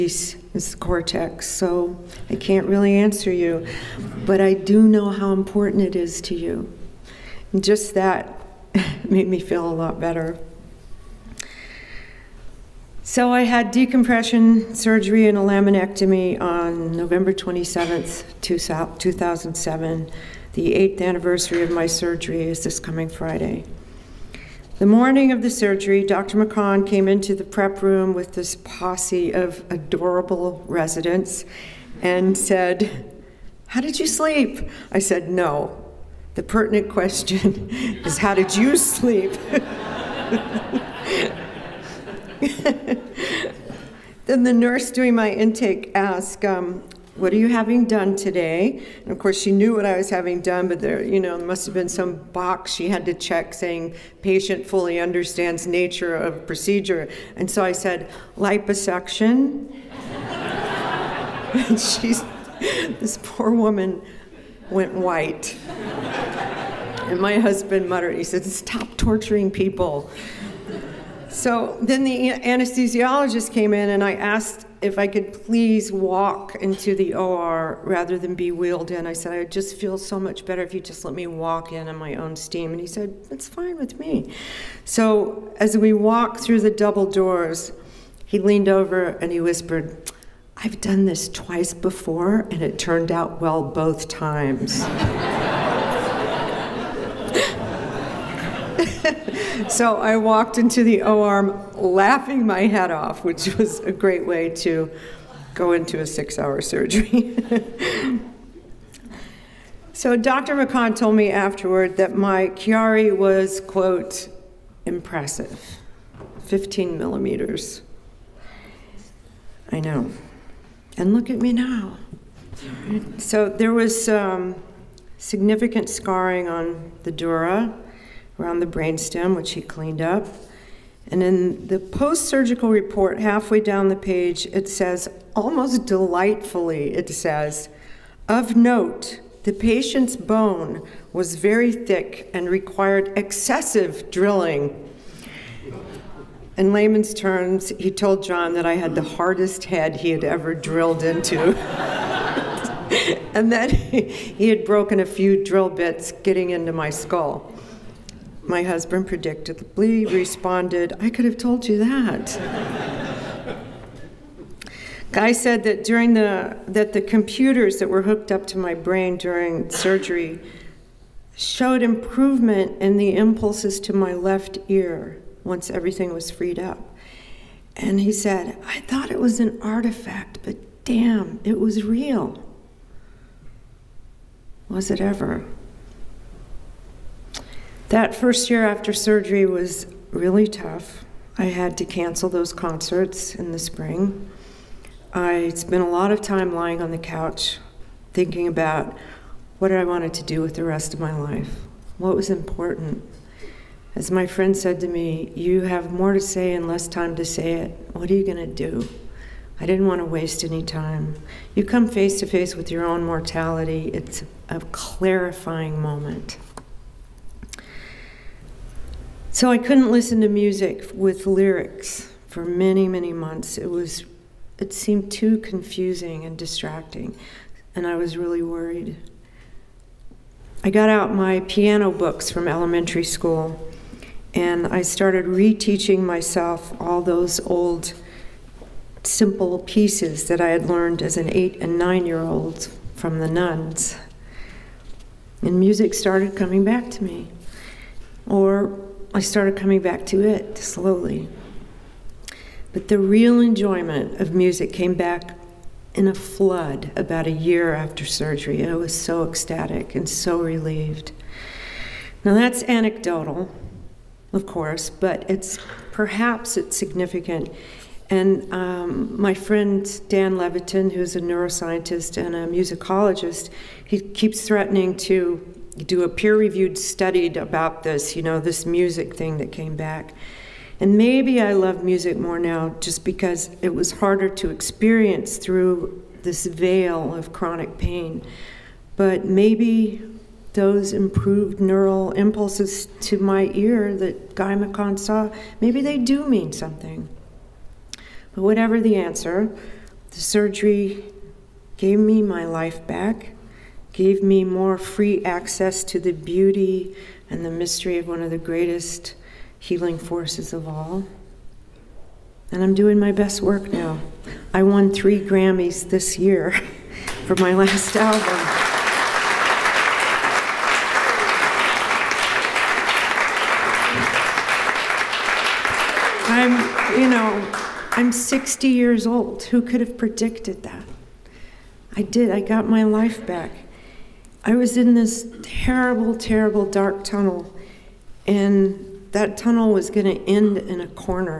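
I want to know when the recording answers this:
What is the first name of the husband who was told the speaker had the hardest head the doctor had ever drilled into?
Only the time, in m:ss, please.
2:28.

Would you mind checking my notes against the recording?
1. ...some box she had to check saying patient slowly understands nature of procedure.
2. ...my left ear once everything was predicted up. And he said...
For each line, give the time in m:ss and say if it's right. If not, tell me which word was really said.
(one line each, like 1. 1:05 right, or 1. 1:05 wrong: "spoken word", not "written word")
1. 0:51 wrong: "fully", not "slowly"
2. 2:53 wrong: "freed", not "predicted".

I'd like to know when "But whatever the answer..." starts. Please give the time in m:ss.
4:58.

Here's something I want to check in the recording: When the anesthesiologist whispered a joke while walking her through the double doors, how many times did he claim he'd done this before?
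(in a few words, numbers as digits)
2.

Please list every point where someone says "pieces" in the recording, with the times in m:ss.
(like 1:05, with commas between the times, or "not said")
3:59.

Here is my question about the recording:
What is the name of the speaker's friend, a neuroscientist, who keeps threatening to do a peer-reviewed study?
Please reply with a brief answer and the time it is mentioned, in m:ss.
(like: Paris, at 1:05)
Dan Levitin, at 4:30.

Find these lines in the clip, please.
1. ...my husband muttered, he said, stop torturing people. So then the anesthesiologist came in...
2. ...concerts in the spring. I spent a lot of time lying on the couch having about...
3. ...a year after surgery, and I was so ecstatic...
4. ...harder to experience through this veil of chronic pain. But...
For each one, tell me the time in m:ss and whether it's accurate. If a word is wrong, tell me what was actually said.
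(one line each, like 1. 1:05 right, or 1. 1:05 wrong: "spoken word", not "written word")
1. 1:07 right
2. 3:12 wrong: "thinking", not "having"
3. 4:17 right
4. 4:43 right.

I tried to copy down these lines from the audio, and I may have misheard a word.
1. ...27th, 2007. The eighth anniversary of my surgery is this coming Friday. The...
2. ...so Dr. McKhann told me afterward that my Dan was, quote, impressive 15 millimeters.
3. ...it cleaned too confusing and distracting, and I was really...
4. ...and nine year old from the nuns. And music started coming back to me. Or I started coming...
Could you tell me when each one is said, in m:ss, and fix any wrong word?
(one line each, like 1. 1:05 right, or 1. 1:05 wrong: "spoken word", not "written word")
1. 0:17 right
2. 1:49 wrong: "Chiari", not "Dan"
3. 3:44 wrong: "seemed", not "cleaned"
4. 4:01 right.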